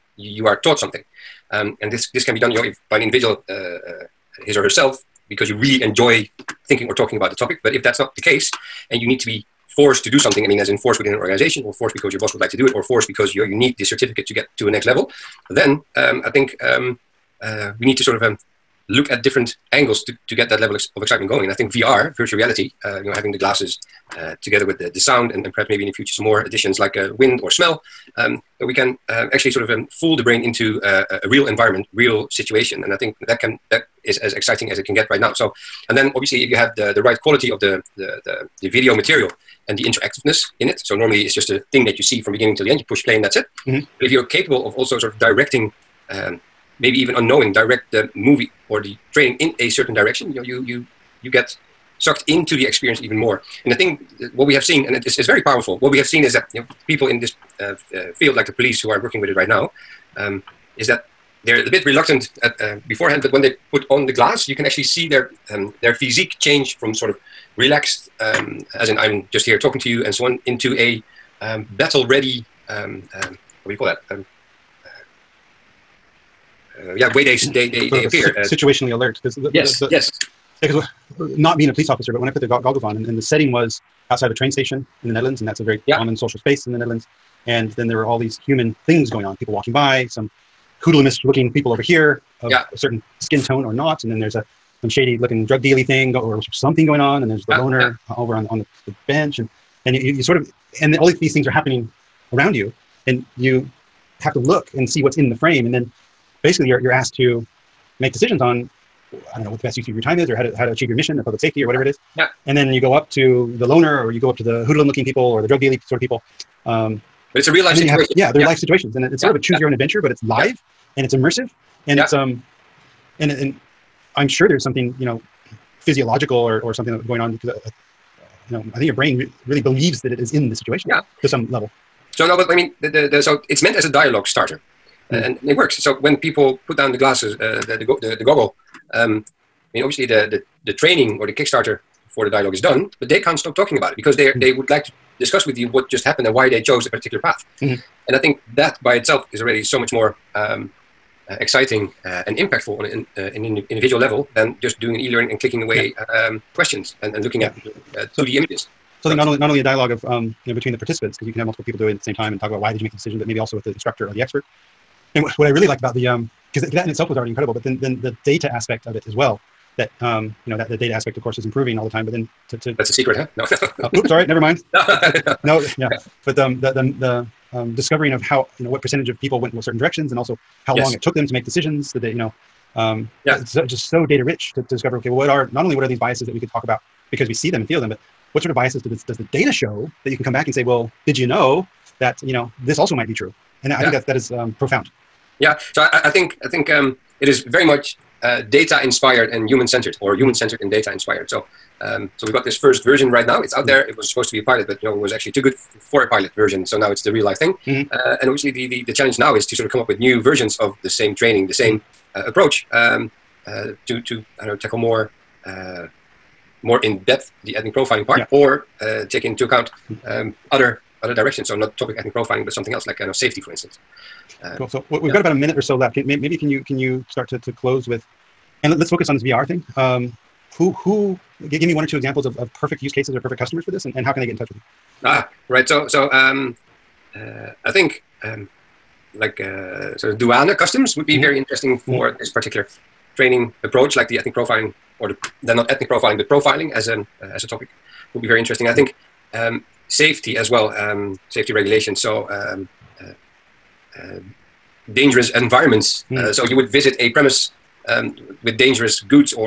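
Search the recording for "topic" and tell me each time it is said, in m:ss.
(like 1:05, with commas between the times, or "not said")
0:07, 3:41, 4:07.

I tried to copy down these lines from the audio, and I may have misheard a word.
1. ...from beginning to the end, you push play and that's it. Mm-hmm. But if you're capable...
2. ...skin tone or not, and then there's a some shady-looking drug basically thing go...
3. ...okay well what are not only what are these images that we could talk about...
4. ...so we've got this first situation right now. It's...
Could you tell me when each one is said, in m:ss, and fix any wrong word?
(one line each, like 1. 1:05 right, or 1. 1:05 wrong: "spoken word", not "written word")
1. 0:42 right
2. 1:33 wrong: "dealy", not "basically"
3. 3:04 wrong: "biases", not "images"
4. 3:22 wrong: "version", not "situation".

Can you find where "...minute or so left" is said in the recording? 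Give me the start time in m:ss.
3:45.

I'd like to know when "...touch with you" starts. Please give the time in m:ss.
3:54.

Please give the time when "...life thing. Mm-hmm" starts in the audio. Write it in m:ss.
3:27.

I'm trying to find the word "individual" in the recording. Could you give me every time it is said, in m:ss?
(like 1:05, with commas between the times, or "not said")
0:03, 2:33.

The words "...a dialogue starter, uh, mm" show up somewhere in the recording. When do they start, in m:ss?
2:13.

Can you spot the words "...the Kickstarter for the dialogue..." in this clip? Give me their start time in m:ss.
2:21.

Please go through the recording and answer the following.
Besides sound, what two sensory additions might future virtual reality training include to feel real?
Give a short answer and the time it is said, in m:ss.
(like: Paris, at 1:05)
wind or smell, at 0:27.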